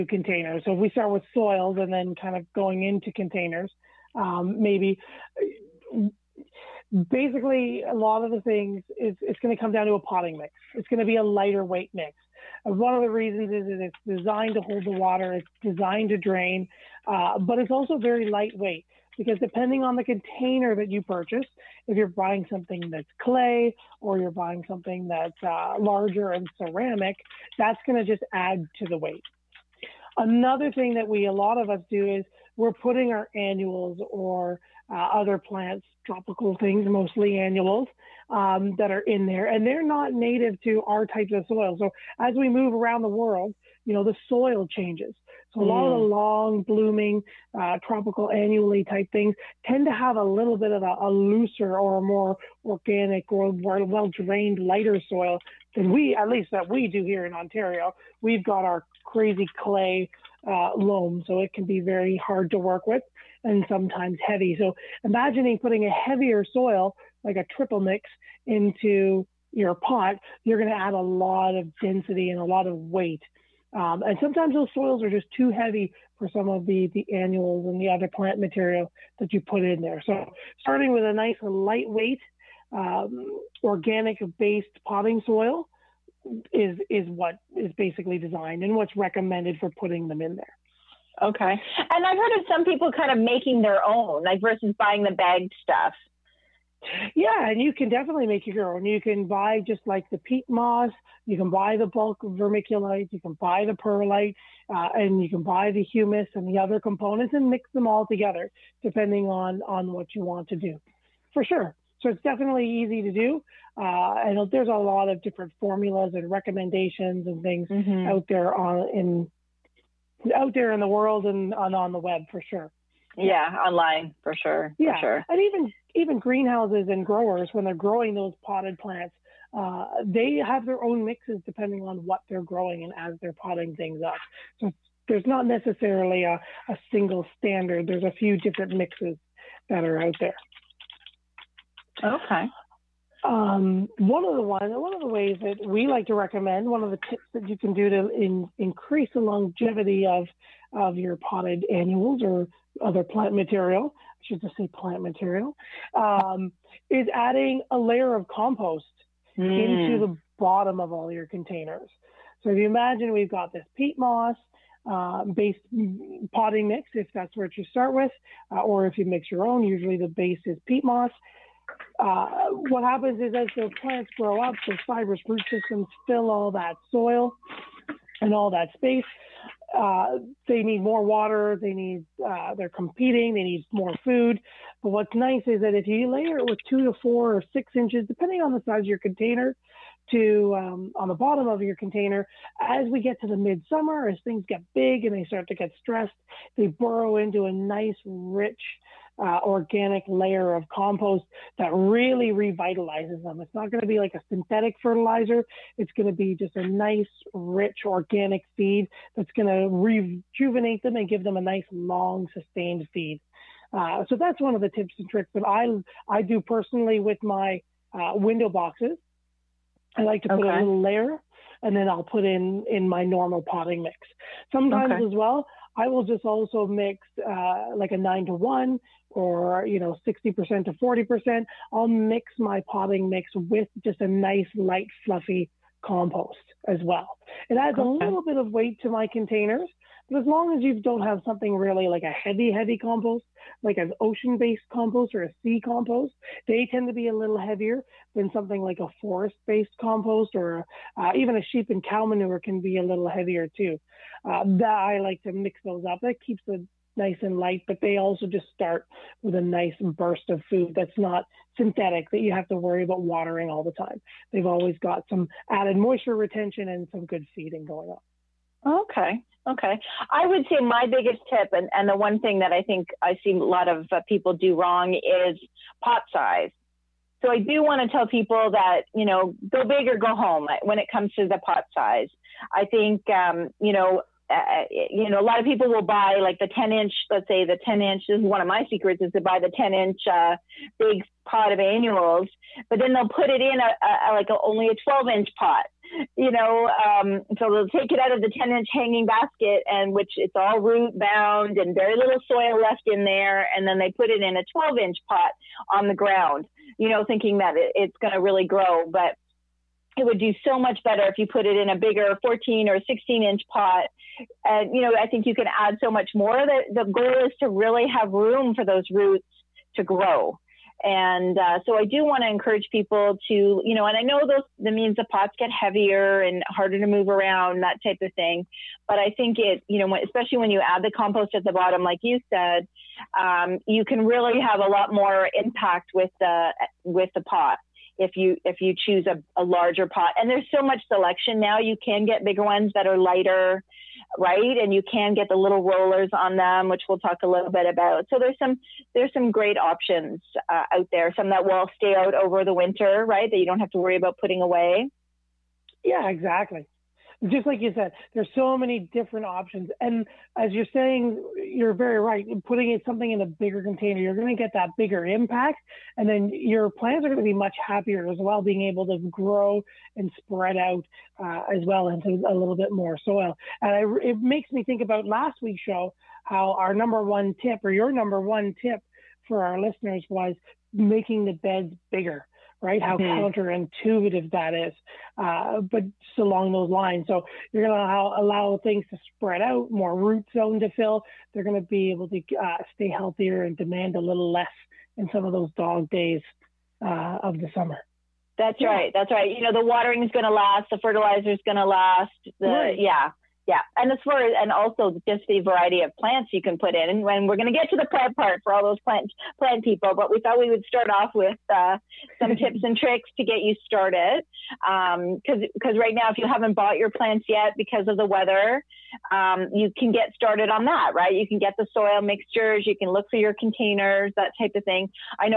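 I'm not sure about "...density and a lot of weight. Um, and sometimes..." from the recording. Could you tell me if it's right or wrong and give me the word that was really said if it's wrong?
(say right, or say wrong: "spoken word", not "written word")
right.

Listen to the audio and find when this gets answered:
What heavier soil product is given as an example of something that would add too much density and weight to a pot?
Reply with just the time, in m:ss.
1:07.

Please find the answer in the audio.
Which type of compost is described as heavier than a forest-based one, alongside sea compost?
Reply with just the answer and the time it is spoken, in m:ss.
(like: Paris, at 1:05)
ocean based compost, at 4:03.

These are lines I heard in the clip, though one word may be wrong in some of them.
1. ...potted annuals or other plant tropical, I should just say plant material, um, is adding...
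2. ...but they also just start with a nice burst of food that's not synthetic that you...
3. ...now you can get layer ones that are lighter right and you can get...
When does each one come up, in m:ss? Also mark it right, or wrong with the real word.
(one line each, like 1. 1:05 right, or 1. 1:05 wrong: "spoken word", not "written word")
1. 2:31 wrong: "material", not "tropical"
2. 4:17 right
3. 5:41 wrong: "bigger", not "layer".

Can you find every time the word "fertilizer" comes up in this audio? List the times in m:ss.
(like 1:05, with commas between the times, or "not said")
3:24, 6:40.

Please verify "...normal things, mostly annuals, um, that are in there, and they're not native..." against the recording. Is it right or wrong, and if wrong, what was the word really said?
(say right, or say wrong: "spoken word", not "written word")
wrong: "tropical", not "normal".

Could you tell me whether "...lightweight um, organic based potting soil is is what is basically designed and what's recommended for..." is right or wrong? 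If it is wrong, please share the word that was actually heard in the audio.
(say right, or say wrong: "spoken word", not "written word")
right.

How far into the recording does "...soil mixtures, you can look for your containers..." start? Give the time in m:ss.
7:01.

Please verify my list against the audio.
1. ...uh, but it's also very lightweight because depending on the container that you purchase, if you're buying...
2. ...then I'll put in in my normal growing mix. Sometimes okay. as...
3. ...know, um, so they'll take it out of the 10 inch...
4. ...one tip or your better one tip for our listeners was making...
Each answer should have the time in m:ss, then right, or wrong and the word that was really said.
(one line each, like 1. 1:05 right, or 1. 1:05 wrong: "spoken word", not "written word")
1. 0:17 right
2. 3:41 wrong: "potting", not "growing"
3. 4:56 right
4. 6:17 wrong: "number", not "better".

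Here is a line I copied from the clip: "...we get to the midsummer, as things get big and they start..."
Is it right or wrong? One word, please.
right.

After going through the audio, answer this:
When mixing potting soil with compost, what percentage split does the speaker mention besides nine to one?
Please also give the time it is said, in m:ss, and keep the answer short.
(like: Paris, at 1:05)
60% to 40%, at 3:50.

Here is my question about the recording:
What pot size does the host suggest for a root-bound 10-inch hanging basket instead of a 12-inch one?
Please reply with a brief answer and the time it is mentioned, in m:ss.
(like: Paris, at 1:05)
14 or 16 inch, at 5:12.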